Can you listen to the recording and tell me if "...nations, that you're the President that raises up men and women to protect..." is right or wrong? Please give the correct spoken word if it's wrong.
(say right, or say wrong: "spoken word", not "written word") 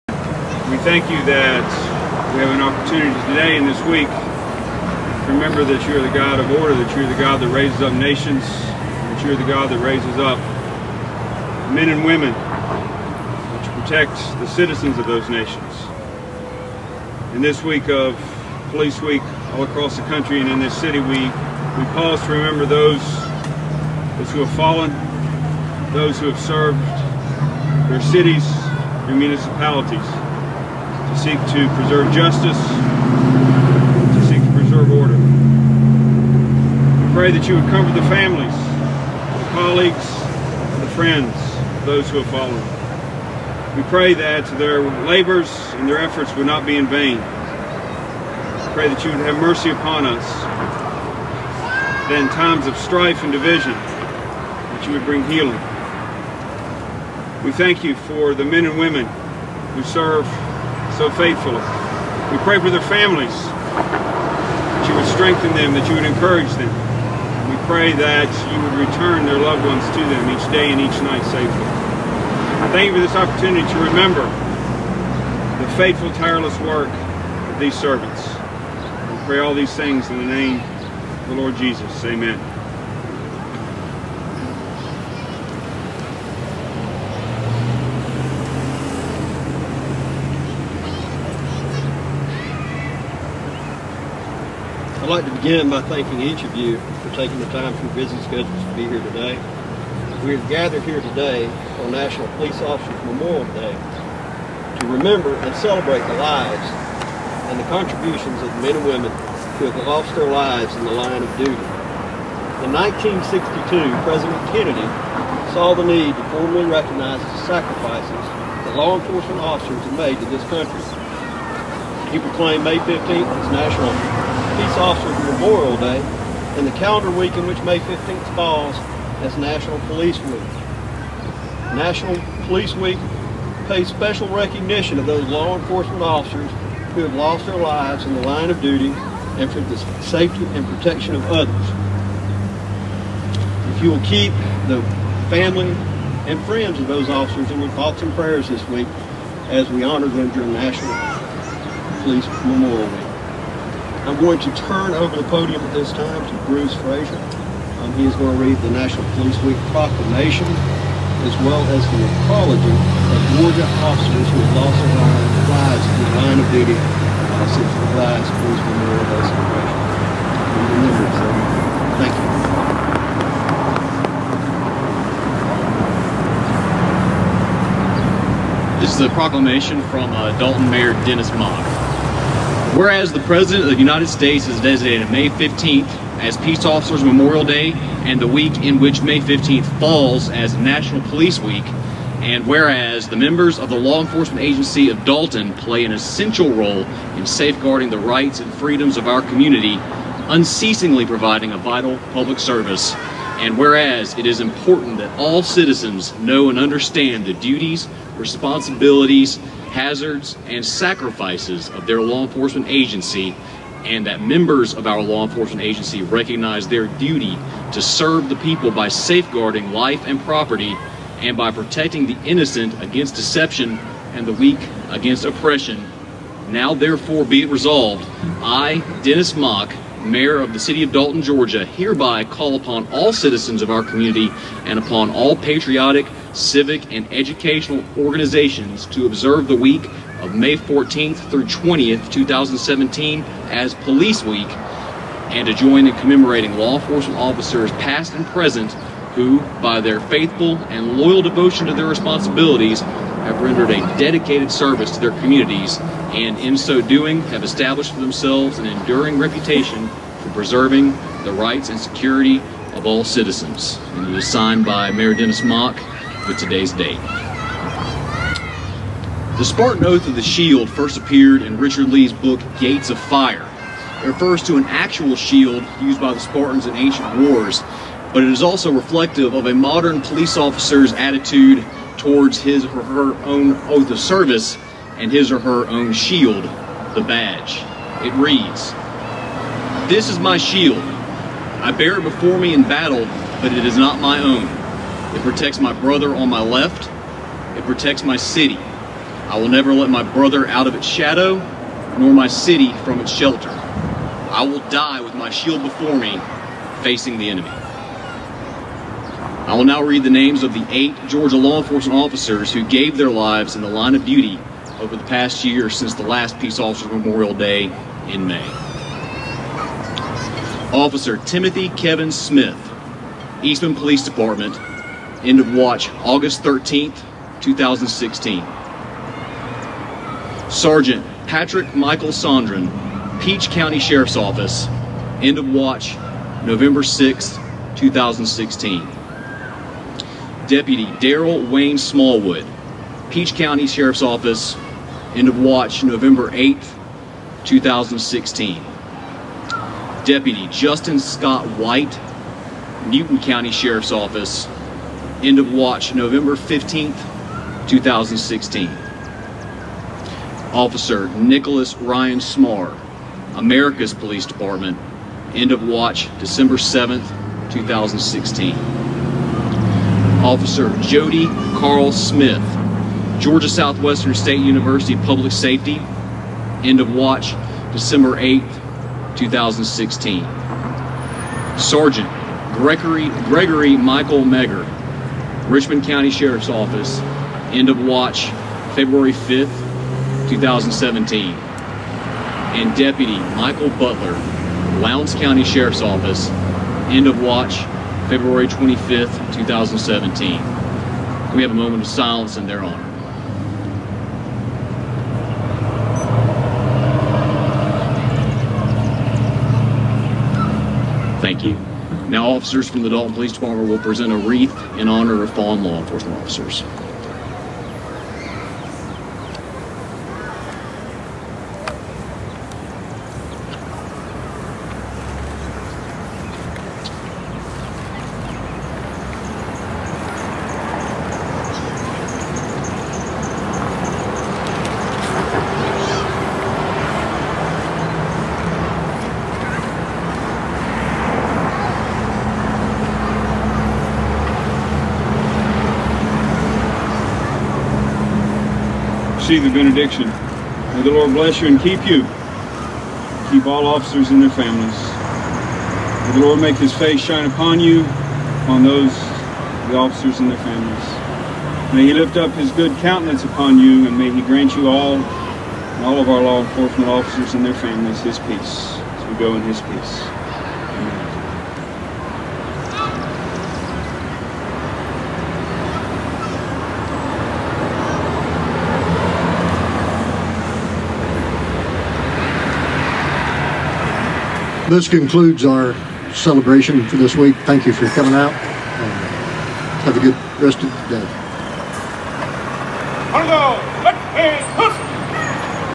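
wrong: "God", not "President".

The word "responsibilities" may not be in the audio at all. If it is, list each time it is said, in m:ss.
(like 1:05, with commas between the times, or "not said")
3:28, 4:11.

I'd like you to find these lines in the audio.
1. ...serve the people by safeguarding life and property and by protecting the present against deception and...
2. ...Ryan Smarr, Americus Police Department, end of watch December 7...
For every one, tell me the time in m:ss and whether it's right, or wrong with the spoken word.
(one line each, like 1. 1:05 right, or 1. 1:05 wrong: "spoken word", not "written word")
1. 3:37 wrong: "innocent", not "present"
2. 6:01 right.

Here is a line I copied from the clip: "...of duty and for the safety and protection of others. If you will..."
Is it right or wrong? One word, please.
right.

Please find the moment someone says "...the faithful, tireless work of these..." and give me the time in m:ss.
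1:15.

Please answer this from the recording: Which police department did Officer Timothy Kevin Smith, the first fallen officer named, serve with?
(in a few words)
Eastman Police Department.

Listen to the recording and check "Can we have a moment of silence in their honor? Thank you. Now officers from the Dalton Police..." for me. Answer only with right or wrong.
right.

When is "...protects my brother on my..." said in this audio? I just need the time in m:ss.
4:55.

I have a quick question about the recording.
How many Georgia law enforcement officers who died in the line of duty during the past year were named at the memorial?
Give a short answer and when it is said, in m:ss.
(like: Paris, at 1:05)
8, at 5:10.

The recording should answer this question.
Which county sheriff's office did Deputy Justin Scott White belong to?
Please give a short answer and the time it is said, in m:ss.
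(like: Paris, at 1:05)
Newton County, at 5:52.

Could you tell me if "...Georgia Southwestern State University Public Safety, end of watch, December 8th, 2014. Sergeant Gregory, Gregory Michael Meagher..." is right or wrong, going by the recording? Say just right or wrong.
wrong.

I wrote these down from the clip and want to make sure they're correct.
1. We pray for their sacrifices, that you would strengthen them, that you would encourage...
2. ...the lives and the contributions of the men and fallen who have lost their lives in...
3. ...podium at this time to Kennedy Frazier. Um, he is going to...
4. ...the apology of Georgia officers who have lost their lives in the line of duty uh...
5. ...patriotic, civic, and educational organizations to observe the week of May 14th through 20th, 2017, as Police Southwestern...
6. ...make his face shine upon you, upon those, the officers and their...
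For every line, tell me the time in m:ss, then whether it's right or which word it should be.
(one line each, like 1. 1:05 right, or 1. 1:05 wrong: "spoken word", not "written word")
1. 1:02 wrong: "families", not "sacrifices"
2. 1:46 wrong: "women", not "fallen"
3. 2:35 wrong: "Bruce", not "Kennedy"
4. 2:41 right
5. 3:55 wrong: "Week", not "Southwestern"
6. 7:36 right.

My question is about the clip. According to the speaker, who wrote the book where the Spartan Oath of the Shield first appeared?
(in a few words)
Richard Lee.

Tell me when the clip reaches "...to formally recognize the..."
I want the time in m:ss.
1:56.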